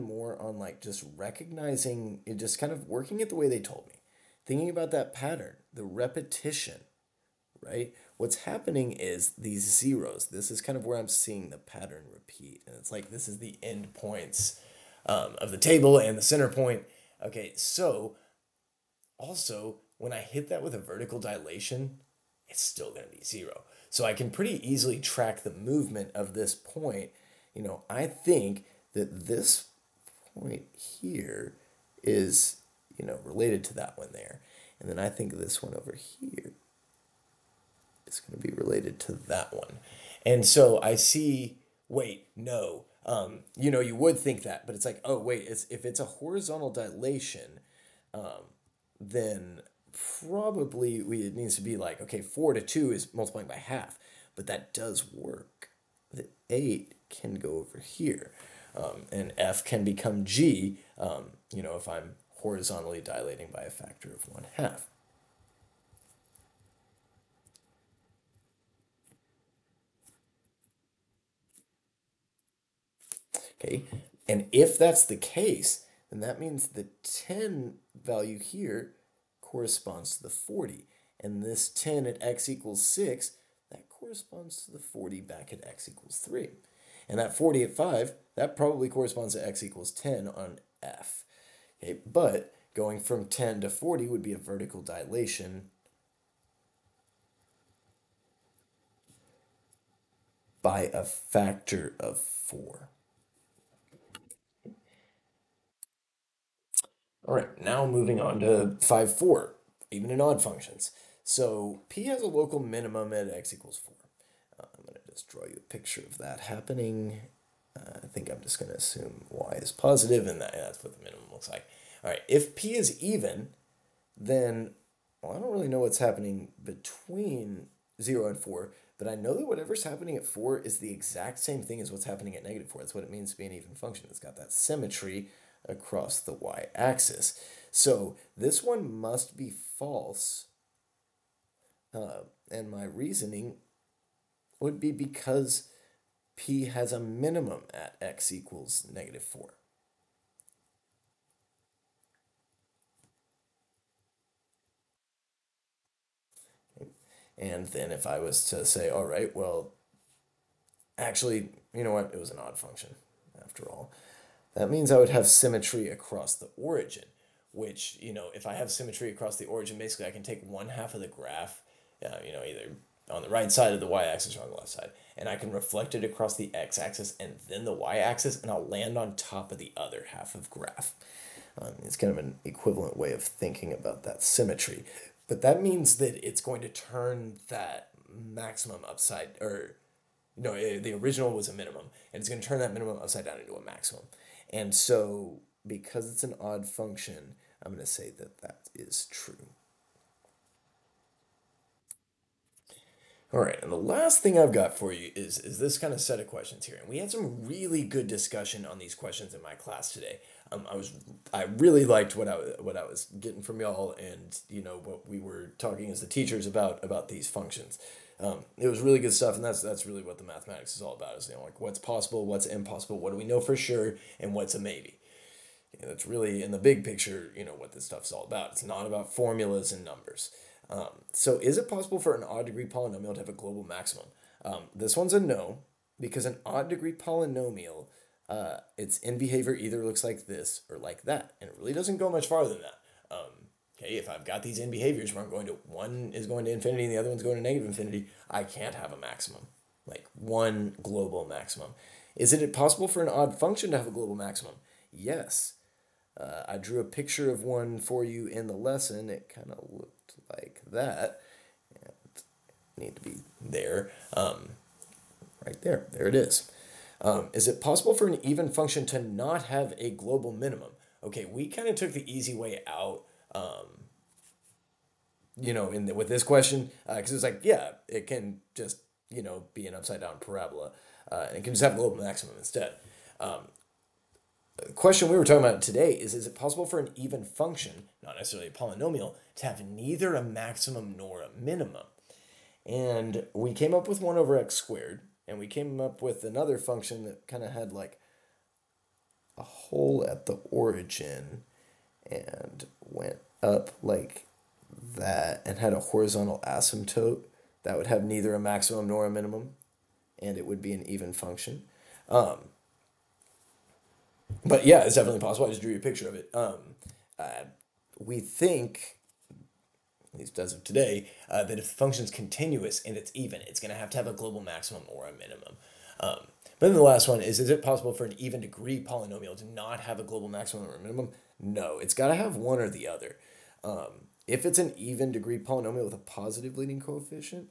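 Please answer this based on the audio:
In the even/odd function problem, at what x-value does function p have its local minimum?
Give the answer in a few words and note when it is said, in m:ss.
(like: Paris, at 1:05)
4, at 1:53.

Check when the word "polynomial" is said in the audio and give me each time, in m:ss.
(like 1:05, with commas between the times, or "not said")
3:52, 3:56, 4:48, 5:28, 5:35.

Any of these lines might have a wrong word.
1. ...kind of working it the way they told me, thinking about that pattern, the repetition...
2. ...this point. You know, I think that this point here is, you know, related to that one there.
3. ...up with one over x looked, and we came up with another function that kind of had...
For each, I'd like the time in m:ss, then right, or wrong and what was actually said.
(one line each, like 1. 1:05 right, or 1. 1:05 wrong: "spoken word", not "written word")
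1. 0:02 right
2. 0:26 right
3. 4:53 wrong: "squared", not "looked".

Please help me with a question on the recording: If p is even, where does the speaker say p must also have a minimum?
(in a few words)
x = -4.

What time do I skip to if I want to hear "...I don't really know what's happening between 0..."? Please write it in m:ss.
2:05.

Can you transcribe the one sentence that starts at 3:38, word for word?
Um, it was really good stuff, and that's that's really what the mathematics is all about.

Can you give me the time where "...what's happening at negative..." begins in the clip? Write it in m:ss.
2:11.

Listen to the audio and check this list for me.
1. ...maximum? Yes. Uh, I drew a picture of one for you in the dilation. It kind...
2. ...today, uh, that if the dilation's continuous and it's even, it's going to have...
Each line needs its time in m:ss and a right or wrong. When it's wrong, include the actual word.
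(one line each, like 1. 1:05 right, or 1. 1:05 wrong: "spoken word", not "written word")
1. 4:14 wrong: "lesson", not "dilation"
2. 5:20 wrong: "function", not "dilation".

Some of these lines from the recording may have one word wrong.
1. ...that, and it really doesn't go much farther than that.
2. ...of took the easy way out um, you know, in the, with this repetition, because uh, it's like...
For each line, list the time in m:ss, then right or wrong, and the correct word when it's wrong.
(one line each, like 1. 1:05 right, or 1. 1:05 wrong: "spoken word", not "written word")
1. 4:01 right
2. 4:31 wrong: "question", not "repetition".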